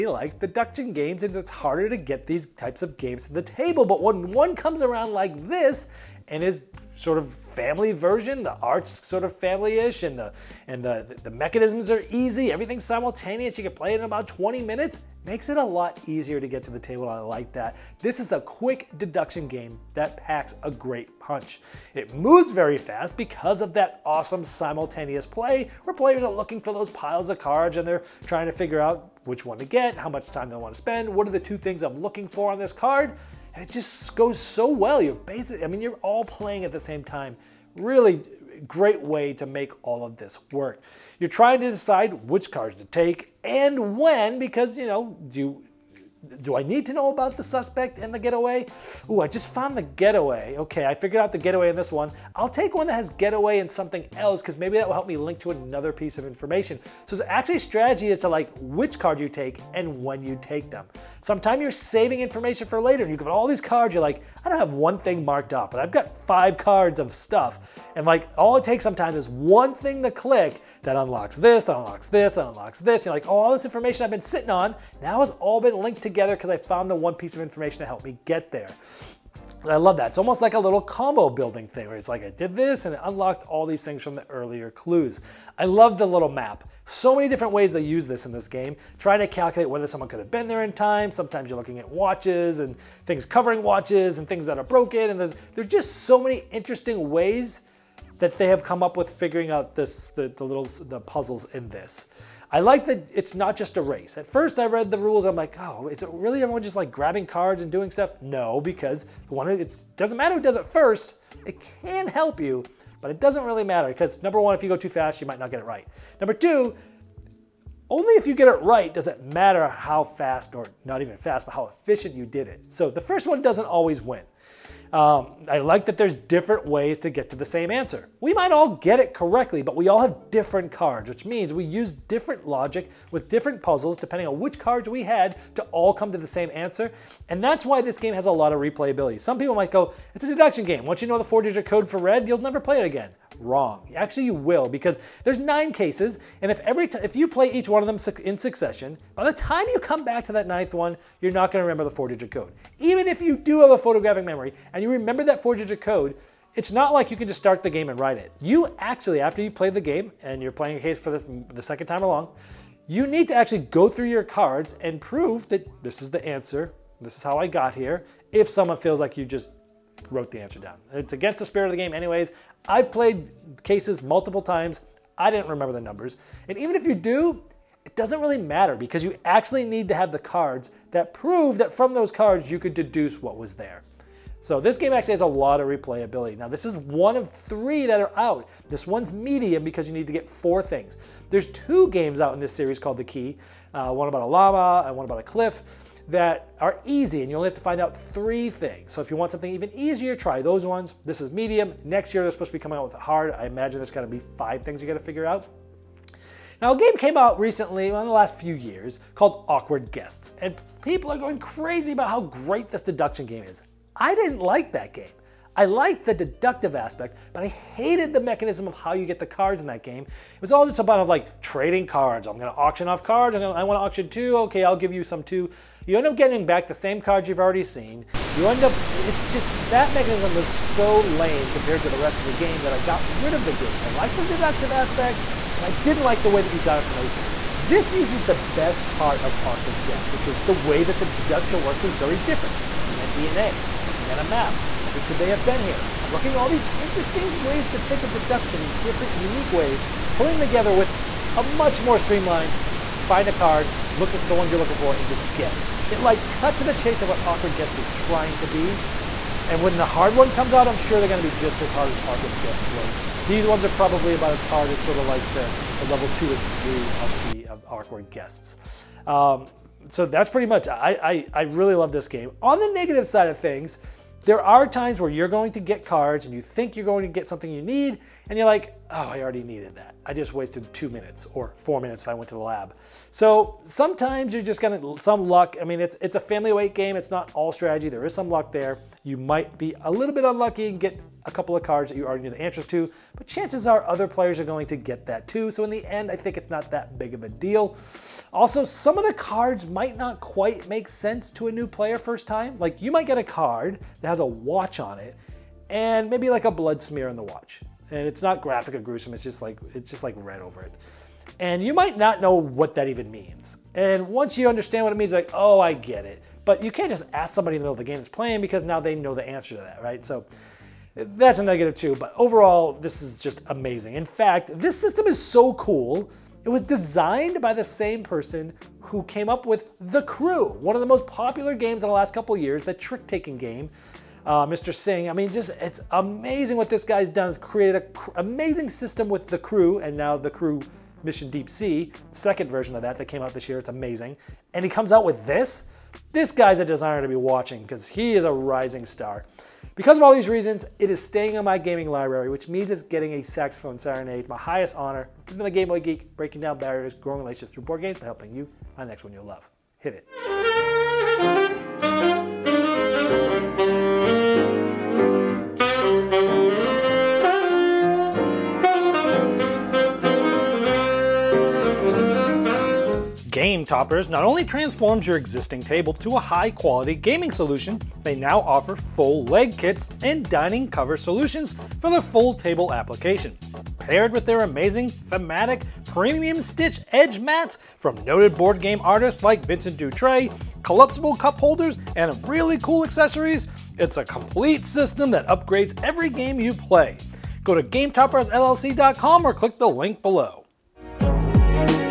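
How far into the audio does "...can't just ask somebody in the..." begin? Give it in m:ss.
5:16.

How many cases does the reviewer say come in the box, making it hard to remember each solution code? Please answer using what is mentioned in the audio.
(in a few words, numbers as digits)
9.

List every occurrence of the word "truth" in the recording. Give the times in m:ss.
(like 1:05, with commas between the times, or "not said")
not said.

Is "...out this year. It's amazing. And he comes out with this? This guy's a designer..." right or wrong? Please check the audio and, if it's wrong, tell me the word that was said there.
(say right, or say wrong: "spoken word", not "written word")
right.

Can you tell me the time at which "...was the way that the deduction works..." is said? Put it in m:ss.
4:00.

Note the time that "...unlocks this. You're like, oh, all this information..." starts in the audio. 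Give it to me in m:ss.
1:12.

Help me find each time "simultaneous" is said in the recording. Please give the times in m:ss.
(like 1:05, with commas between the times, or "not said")
0:12, 0:24.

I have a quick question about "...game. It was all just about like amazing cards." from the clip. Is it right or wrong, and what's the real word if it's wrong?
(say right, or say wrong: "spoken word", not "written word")
wrong: "trading", not "amazing".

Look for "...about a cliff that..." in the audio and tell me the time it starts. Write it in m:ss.
3:15.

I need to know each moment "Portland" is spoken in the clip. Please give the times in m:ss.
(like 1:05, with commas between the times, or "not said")
not said.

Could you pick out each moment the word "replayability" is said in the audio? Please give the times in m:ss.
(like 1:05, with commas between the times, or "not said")
2:18, 3:05.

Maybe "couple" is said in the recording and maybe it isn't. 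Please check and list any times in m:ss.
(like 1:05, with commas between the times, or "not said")
4:51, 5:32.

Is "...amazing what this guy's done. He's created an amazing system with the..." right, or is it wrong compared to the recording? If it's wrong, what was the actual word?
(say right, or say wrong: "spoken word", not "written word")
right.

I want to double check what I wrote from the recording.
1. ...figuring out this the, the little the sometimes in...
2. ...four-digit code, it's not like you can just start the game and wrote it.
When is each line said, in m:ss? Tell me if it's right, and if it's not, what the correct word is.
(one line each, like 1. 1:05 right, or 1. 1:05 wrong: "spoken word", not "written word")
1. 1:39 wrong: "puzzles", not "sometimes"
2. 2:35 wrong: "write", not "wrote".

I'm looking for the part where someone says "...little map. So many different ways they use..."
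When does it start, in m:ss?
1:26.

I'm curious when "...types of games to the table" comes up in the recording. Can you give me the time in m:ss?
0:02.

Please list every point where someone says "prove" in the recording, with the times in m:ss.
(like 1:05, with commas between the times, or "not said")
2:45, 3:01.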